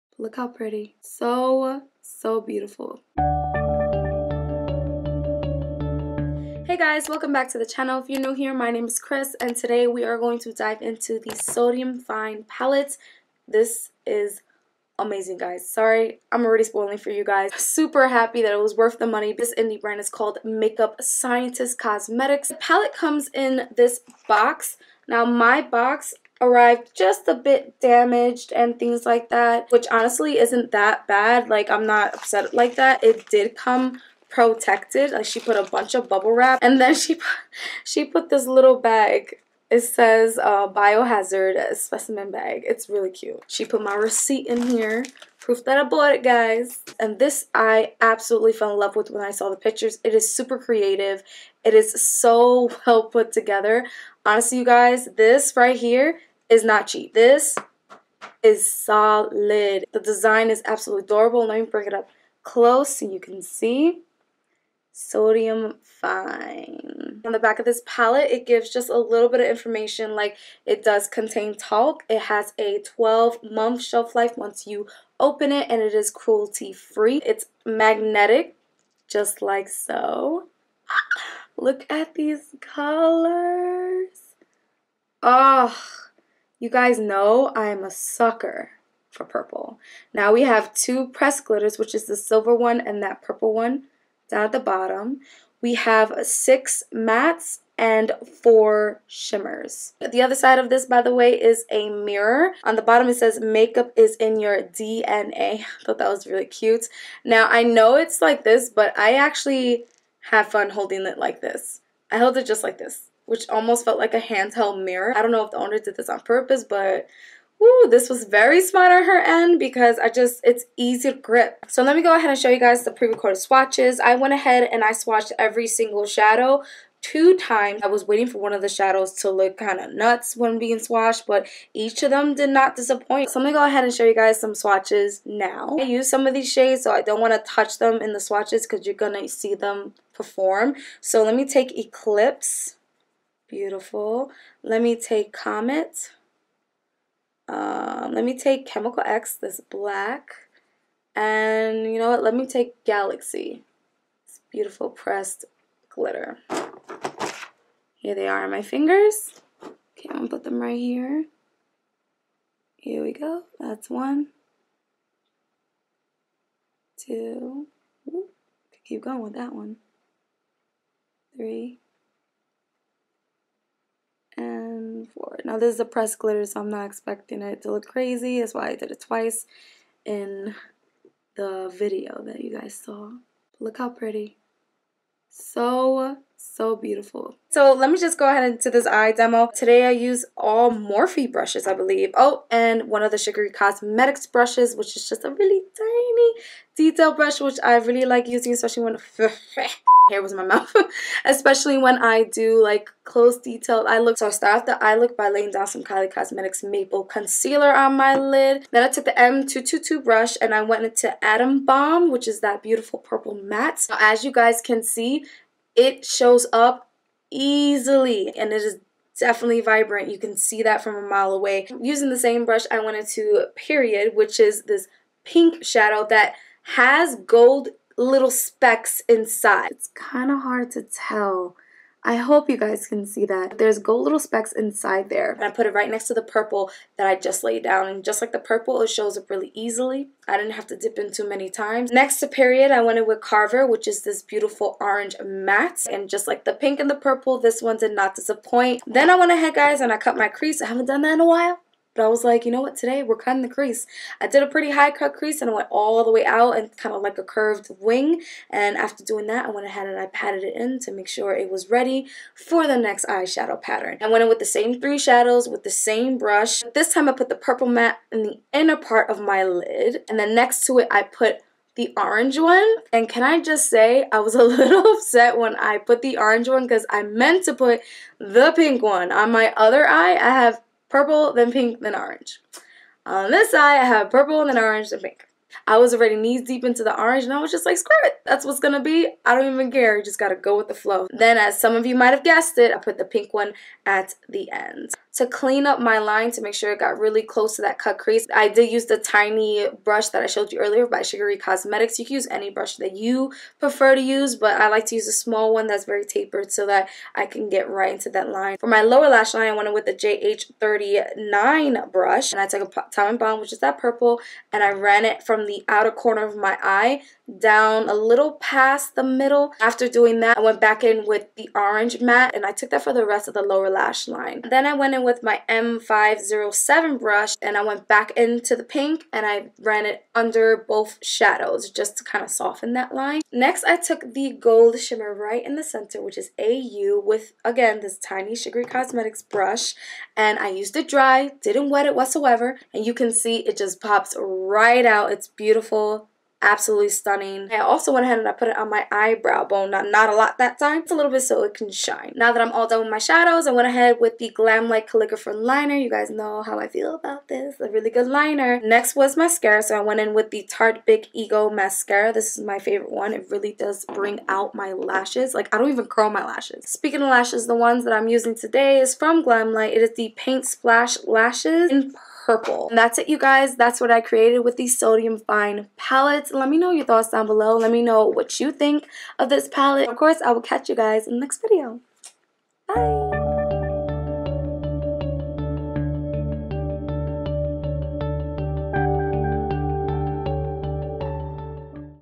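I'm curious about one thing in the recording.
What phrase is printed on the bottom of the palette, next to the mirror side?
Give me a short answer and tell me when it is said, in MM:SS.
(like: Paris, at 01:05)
Makeup is in your DNA, at 01:43.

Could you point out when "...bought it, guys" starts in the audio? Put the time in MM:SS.
00:45.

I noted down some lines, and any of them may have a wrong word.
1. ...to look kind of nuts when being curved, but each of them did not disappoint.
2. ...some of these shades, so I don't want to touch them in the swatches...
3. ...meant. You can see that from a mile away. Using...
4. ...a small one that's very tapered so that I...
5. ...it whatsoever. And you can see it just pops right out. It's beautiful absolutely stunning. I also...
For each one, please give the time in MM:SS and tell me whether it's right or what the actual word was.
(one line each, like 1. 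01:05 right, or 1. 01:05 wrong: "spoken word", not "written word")
1. 02:09 wrong: "swatched", not "curved"
2. 02:16 right
3. 03:39 wrong: "vibrant", not "meant"
4. 05:05 right
5. 05:41 right.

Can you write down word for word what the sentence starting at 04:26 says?
This time I put the purple matte in the inner part of my lid.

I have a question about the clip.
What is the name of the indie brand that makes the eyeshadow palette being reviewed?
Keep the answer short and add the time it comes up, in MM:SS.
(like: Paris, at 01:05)
Makeup Scientist Cosmetics, at 00:20.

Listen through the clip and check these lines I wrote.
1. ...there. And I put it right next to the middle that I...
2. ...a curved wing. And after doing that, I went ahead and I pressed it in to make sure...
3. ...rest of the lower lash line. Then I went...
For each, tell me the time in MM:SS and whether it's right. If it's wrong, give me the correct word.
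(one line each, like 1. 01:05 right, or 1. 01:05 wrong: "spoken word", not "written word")
1. 03:55 wrong: "purple", not "middle"
2. 04:17 wrong: "patted", not "pressed"
3. 05:23 right.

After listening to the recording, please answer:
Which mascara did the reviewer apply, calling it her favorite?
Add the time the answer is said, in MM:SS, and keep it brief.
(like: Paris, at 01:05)
Tarte Big Ego, at 06:00.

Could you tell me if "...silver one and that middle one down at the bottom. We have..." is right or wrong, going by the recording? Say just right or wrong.
wrong.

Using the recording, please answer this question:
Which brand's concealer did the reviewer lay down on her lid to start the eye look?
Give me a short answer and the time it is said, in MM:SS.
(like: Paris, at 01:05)
Kylie Cosmetics, at 03:25.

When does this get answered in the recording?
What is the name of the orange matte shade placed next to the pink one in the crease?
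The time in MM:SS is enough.
04:03.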